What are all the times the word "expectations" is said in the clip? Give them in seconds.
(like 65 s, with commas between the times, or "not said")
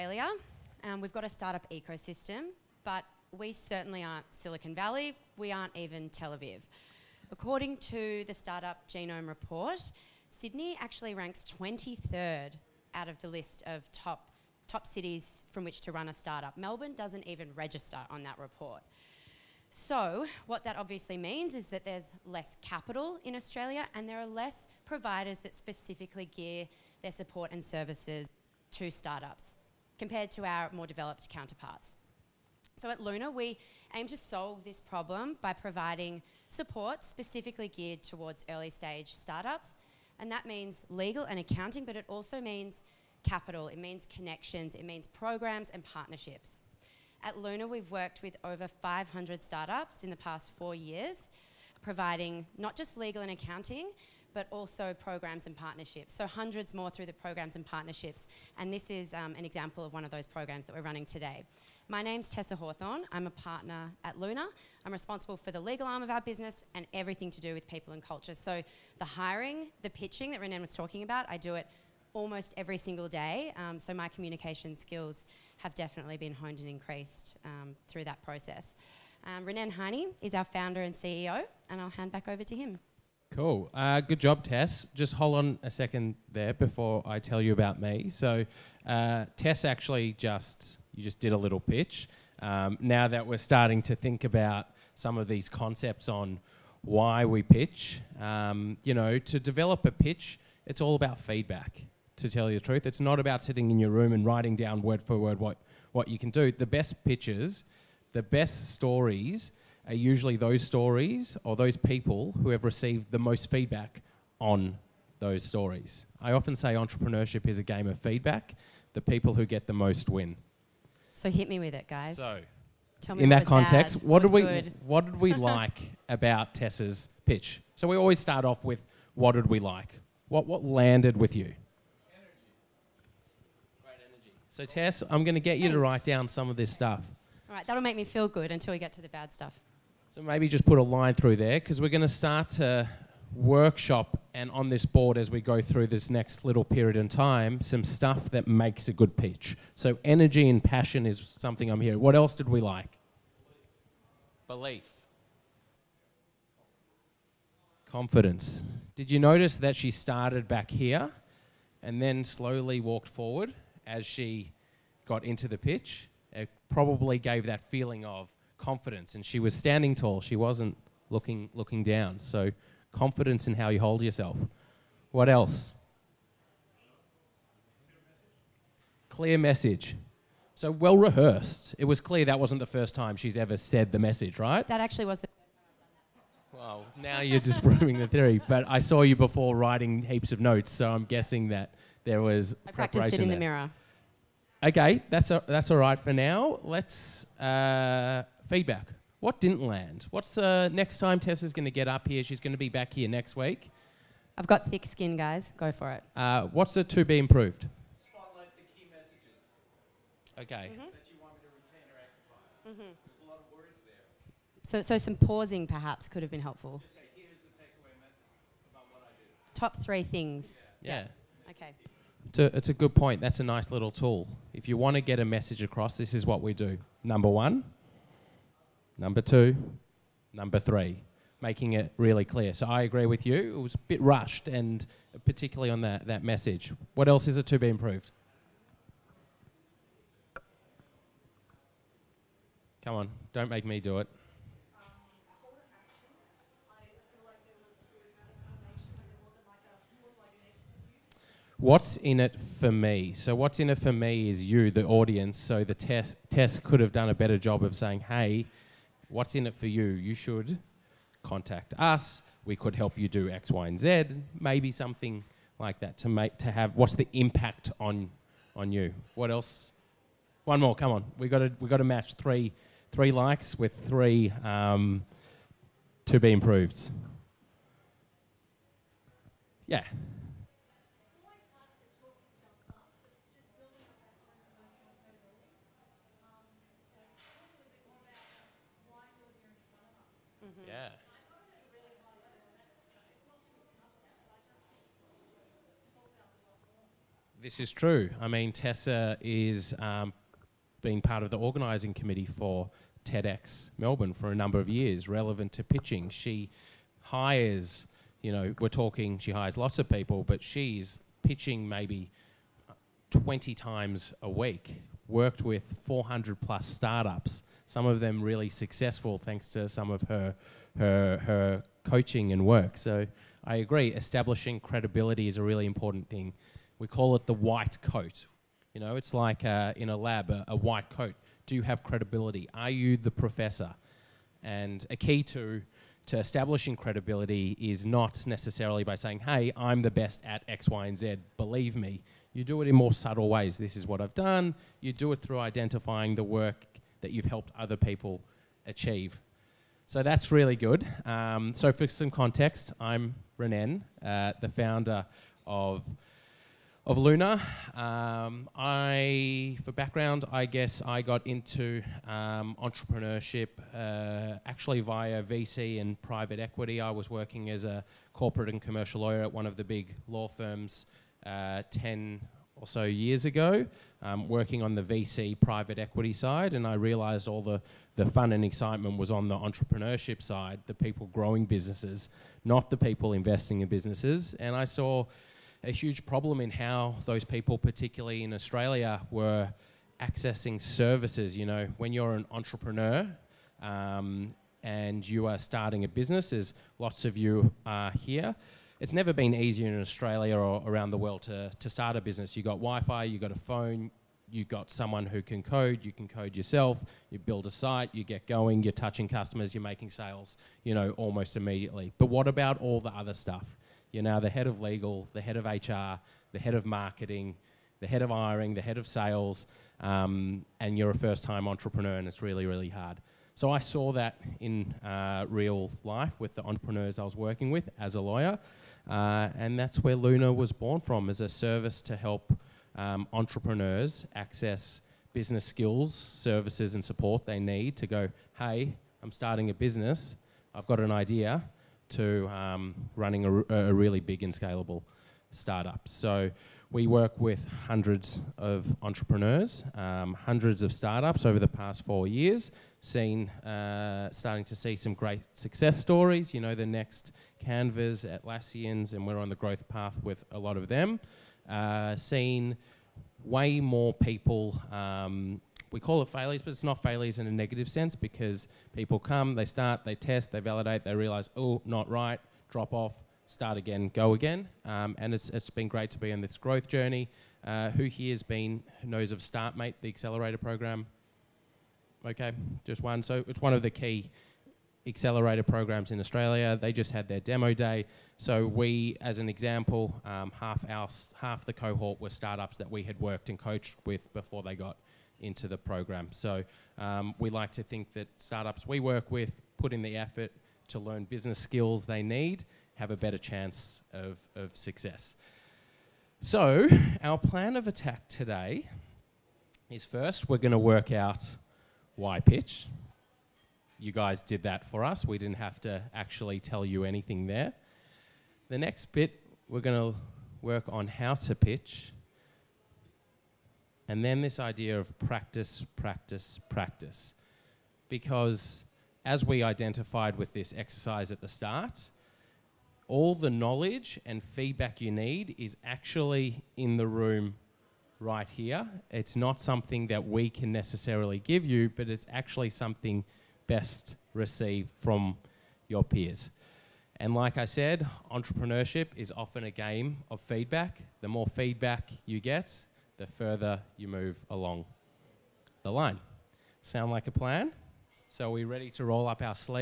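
not said.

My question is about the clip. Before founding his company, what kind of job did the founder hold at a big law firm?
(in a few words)
corporate and commercial lawyer.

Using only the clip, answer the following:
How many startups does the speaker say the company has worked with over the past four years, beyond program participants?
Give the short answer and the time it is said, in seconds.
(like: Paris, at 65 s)
over 500, at 48 s.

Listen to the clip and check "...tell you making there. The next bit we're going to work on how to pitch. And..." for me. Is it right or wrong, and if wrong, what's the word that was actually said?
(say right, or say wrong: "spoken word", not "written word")
wrong: "anything", not "making".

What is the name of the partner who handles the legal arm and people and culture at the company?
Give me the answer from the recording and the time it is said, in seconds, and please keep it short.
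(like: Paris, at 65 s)
Tessa Hawthorn, at 62 s.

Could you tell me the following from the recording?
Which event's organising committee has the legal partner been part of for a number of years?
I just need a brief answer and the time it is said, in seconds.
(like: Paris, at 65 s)
TEDx Melbourne, at 303 s.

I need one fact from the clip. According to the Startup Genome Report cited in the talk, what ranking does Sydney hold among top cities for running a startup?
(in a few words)
23rd.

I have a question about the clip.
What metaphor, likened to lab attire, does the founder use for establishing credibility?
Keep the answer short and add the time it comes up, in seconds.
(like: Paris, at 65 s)
the white coat, at 327 s.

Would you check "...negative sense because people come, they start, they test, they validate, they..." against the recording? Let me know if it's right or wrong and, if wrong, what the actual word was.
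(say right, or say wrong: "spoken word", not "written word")
right.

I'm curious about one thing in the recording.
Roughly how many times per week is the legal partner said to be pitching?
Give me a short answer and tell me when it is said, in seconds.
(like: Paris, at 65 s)
20, at 313 s.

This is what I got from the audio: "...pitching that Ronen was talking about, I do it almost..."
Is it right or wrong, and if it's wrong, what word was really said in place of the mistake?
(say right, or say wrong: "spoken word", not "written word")
right.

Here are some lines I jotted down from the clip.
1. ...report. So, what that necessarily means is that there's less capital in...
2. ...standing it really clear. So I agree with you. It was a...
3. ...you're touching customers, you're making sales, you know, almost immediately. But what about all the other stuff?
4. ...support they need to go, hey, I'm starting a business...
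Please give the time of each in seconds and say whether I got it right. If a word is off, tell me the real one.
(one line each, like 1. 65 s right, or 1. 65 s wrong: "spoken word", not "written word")
1. 18 s wrong: "obviously", not "necessarily"
2. 231 s wrong: "making", not "standing"
3. 408 s right
4. 436 s right.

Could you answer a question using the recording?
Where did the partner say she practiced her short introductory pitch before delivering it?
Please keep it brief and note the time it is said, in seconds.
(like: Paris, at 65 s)
in the mirror, at 193 s.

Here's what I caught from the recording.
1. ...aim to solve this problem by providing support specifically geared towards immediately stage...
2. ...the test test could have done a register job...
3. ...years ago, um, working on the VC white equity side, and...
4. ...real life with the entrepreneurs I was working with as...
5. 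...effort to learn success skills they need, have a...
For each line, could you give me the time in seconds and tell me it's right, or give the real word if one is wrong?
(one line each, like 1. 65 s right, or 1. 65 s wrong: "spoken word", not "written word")
1. 33 s wrong: "early", not "immediately"
2. 255 s wrong: "better", not "register"
3. 372 s wrong: "private", not "white"
4. 425 s right
5. 499 s wrong: "business", not "success".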